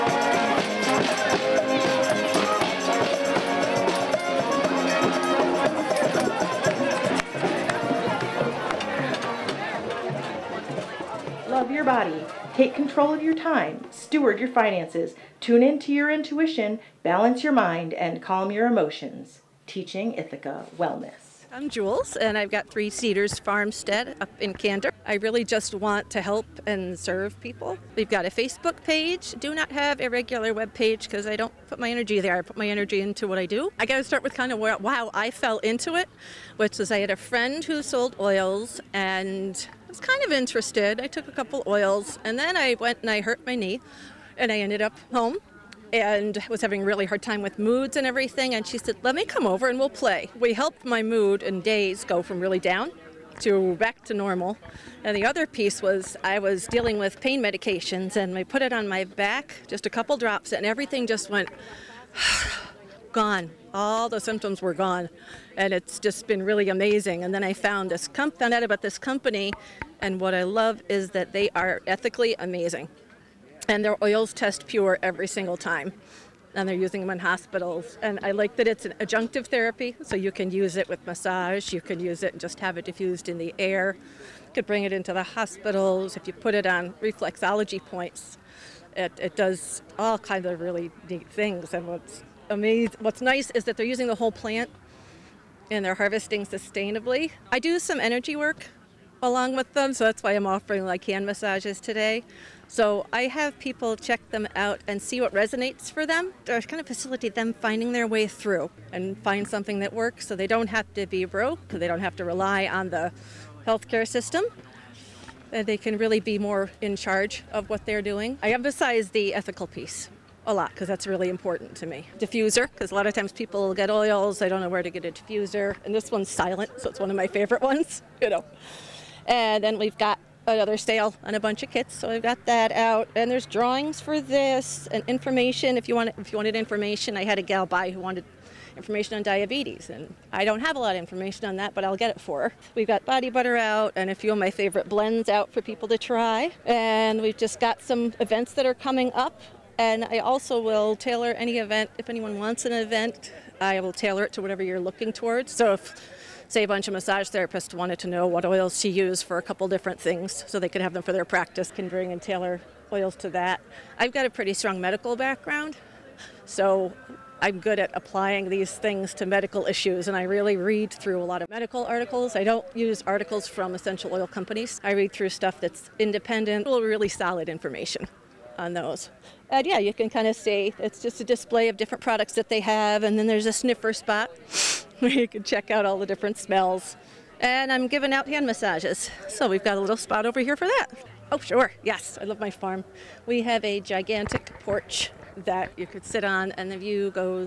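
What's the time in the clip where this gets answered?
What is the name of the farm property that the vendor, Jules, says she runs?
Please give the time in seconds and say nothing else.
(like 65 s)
22 s.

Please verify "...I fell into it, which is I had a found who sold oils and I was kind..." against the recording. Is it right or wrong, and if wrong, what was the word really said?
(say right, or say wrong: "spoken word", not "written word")
wrong: "friend", not "found".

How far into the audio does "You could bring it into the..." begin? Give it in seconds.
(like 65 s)
84 s.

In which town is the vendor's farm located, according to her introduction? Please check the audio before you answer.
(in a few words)
Candor.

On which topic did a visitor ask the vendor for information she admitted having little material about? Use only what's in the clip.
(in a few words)
diabetes.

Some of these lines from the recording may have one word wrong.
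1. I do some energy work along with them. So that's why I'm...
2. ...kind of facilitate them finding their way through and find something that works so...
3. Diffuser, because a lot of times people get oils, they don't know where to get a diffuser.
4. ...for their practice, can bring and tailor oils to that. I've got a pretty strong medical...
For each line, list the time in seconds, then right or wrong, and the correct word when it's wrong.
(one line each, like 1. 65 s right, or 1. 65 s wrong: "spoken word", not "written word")
1. 97 s right
2. 106 s right
3. 122 s right
4. 161 s right.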